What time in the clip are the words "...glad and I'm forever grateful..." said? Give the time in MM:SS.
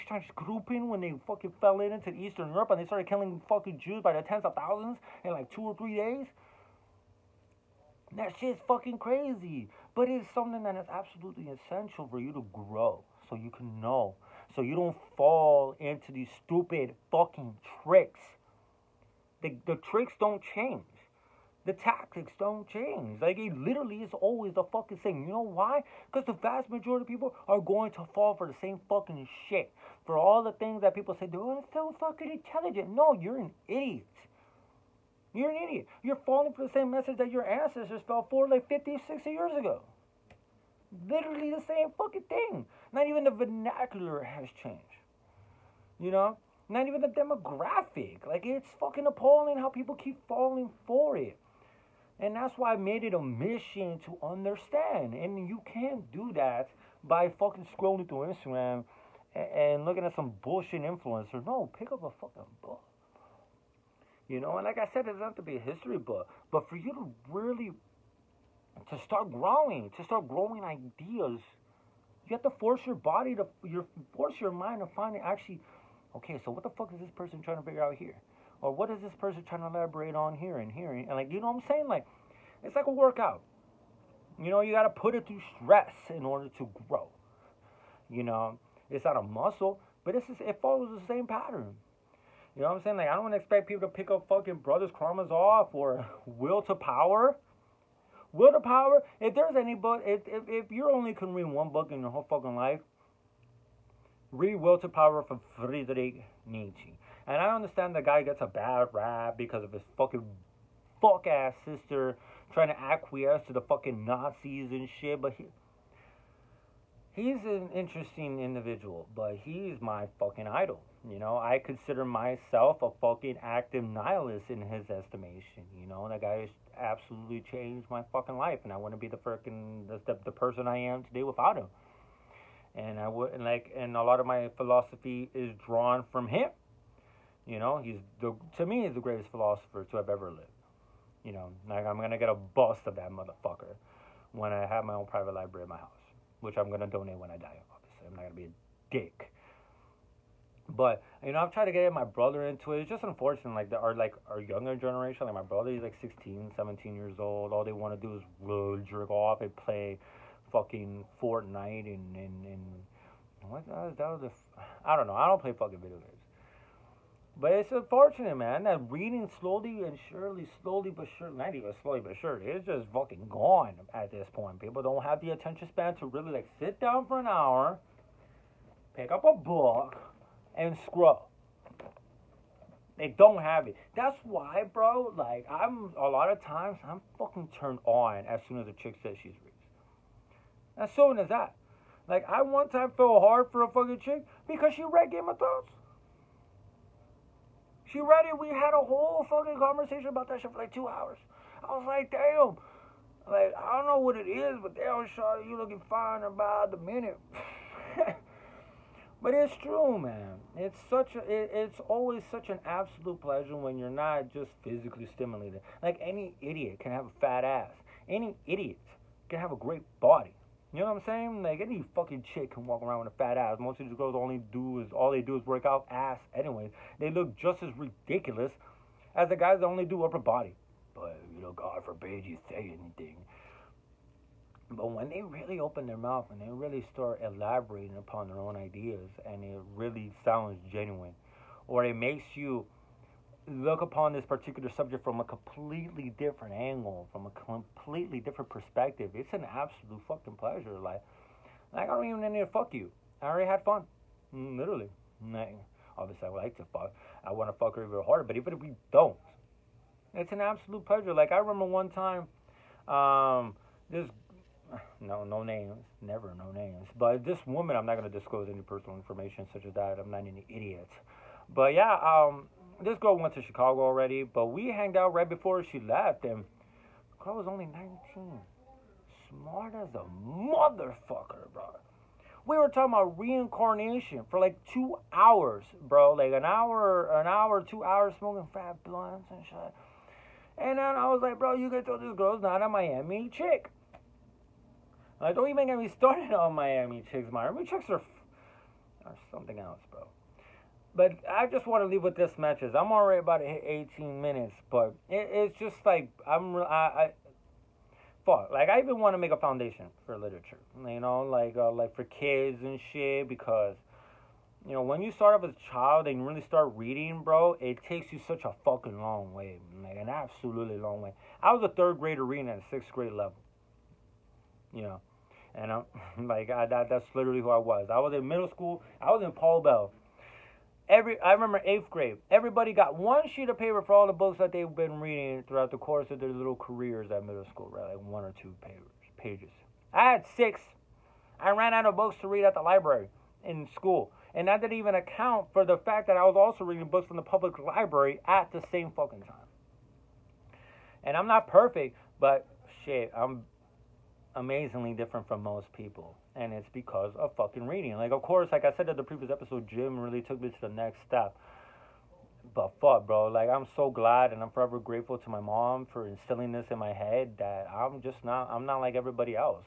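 06:03.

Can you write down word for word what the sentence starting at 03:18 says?
We had a whole fucking conversation about that shit for like two hours.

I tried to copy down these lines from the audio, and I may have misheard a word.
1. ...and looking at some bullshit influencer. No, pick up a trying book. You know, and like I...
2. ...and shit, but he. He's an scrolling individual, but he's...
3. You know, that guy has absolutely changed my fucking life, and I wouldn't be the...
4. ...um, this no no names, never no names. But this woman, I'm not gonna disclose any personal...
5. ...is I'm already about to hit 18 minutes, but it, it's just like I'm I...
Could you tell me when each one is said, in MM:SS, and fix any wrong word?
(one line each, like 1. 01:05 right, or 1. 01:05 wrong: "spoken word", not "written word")
1. 00:59 wrong: "fucking", not "trying"
2. 01:54 wrong: "interesting", not "scrolling"
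3. 02:05 right
4. 04:22 right
5. 05:02 right.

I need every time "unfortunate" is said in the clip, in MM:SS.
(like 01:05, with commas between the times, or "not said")
02:33, 02:47.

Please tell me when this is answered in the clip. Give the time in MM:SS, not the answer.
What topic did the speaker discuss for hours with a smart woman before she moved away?
04:43.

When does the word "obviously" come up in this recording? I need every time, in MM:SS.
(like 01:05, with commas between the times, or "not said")
02:27, 04:15.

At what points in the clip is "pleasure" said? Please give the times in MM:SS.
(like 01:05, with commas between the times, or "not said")
03:33, 04:10, 04:20.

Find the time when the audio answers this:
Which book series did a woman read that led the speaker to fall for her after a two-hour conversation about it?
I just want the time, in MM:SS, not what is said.
03:15.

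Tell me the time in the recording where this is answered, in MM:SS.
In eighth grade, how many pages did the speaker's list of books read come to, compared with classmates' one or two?
05:40.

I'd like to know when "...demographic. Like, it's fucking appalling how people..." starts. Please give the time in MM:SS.
00:47.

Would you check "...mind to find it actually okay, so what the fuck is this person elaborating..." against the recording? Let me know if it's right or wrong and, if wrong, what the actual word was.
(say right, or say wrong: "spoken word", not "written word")
wrong: "trying", not "elaborating".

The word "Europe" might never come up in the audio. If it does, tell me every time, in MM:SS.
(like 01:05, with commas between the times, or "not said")
00:02.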